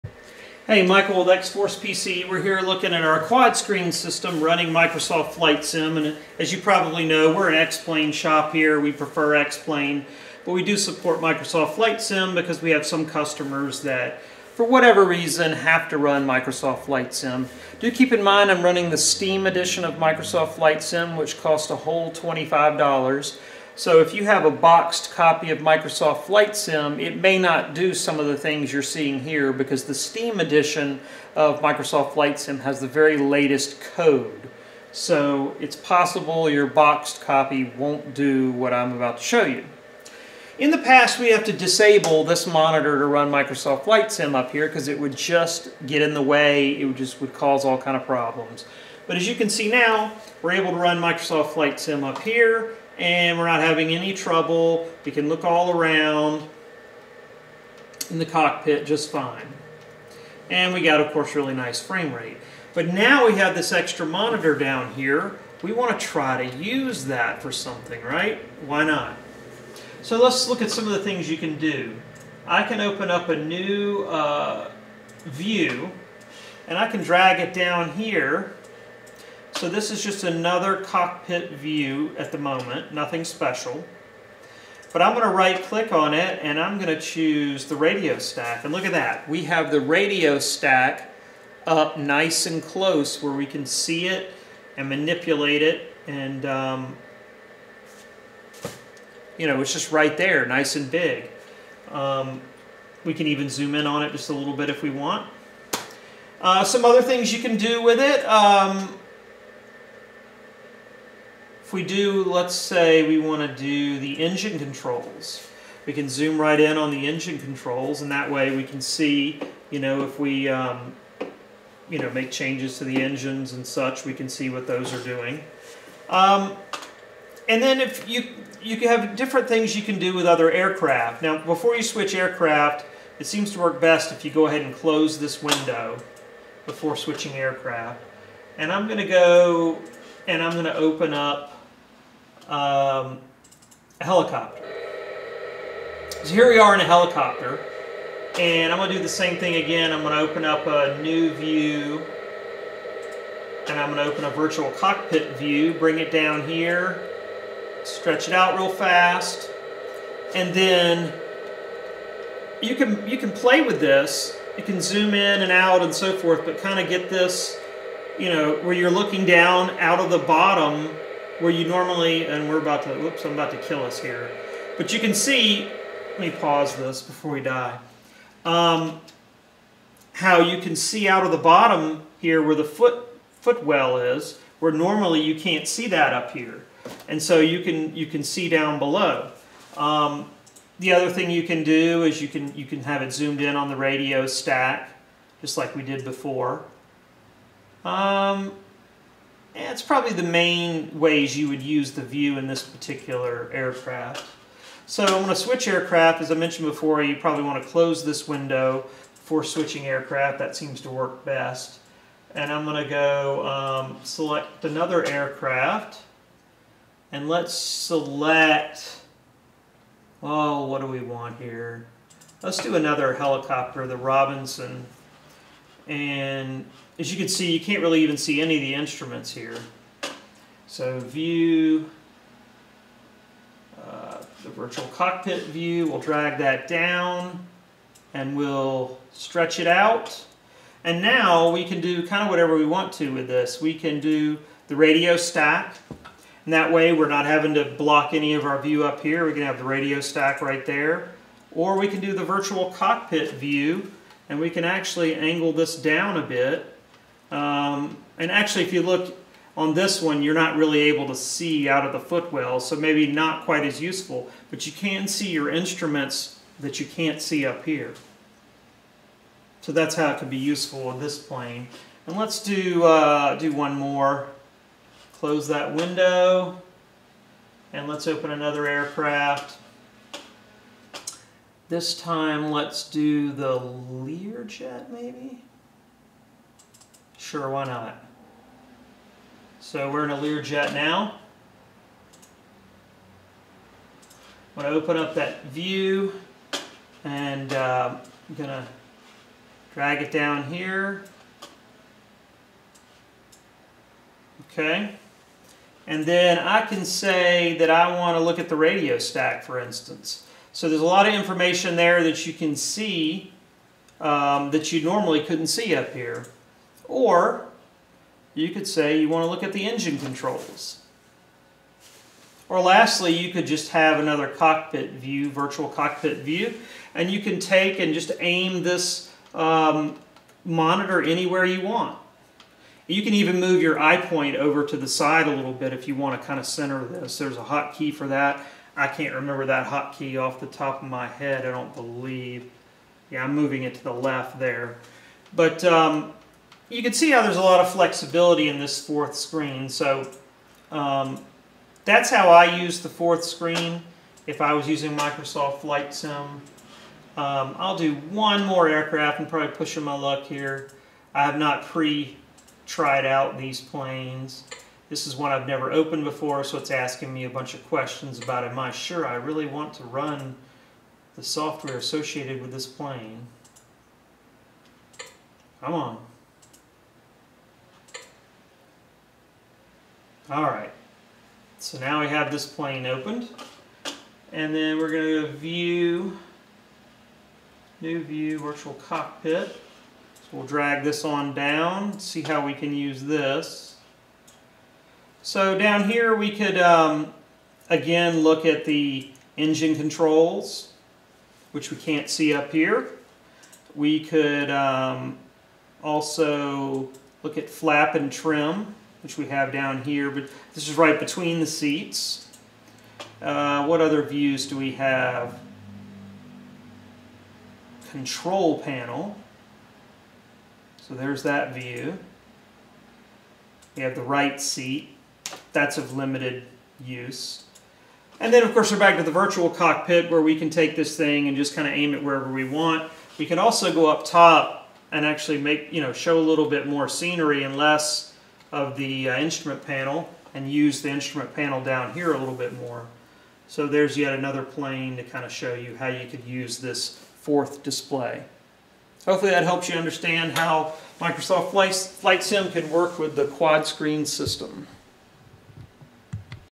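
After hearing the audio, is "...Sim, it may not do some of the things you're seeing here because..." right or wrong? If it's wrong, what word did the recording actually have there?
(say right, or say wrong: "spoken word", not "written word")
right.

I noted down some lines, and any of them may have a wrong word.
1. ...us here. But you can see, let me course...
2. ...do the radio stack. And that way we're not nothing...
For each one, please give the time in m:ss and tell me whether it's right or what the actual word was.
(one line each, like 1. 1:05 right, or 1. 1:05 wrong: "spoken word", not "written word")
1. 2:53 wrong: "pause", not "course"
2. 4:03 wrong: "having", not "nothing".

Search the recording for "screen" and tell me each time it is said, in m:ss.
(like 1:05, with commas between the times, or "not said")
0:03, 5:49, 5:53, 7:33.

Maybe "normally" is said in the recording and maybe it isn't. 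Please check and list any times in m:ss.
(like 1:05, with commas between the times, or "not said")
2:51, 3:04, 5:14.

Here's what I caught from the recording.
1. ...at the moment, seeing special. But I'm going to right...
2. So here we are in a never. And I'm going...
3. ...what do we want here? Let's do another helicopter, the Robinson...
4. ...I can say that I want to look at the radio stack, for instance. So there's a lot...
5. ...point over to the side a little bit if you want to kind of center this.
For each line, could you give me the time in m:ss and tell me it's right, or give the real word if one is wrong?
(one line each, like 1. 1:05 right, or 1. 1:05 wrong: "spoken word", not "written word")
1. 1:22 wrong: "nothing", not "seeing"
2. 2:26 wrong: "helicopter", not "never"
3. 3:40 right
4. 5:06 right
5. 5:34 right.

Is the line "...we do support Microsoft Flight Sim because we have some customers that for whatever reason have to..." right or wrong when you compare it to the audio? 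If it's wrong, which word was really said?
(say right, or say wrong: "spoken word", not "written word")
right.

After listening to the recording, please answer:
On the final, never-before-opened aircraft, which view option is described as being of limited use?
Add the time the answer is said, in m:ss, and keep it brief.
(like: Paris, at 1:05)
right seat, at 7:04.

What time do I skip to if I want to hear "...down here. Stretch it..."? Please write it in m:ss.
2:36.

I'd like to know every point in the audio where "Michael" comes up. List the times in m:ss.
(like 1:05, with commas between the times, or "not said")
0:00.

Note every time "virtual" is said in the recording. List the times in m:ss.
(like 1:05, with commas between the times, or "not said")
2:34, 3:54, 4:12, 5:25, 6:28, 7:09.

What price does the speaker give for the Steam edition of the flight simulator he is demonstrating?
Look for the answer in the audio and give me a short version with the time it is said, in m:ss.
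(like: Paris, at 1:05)
$25, at 0:22.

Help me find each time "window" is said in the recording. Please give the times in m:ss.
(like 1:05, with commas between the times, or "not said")
2:15, 3:28, 4:35.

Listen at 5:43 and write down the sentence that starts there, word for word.
Yeah, I'm moving it to the left there.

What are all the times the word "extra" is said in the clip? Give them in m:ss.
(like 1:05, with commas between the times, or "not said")
1:03.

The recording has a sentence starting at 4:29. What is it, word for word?
So that's how it could be useful on this plane.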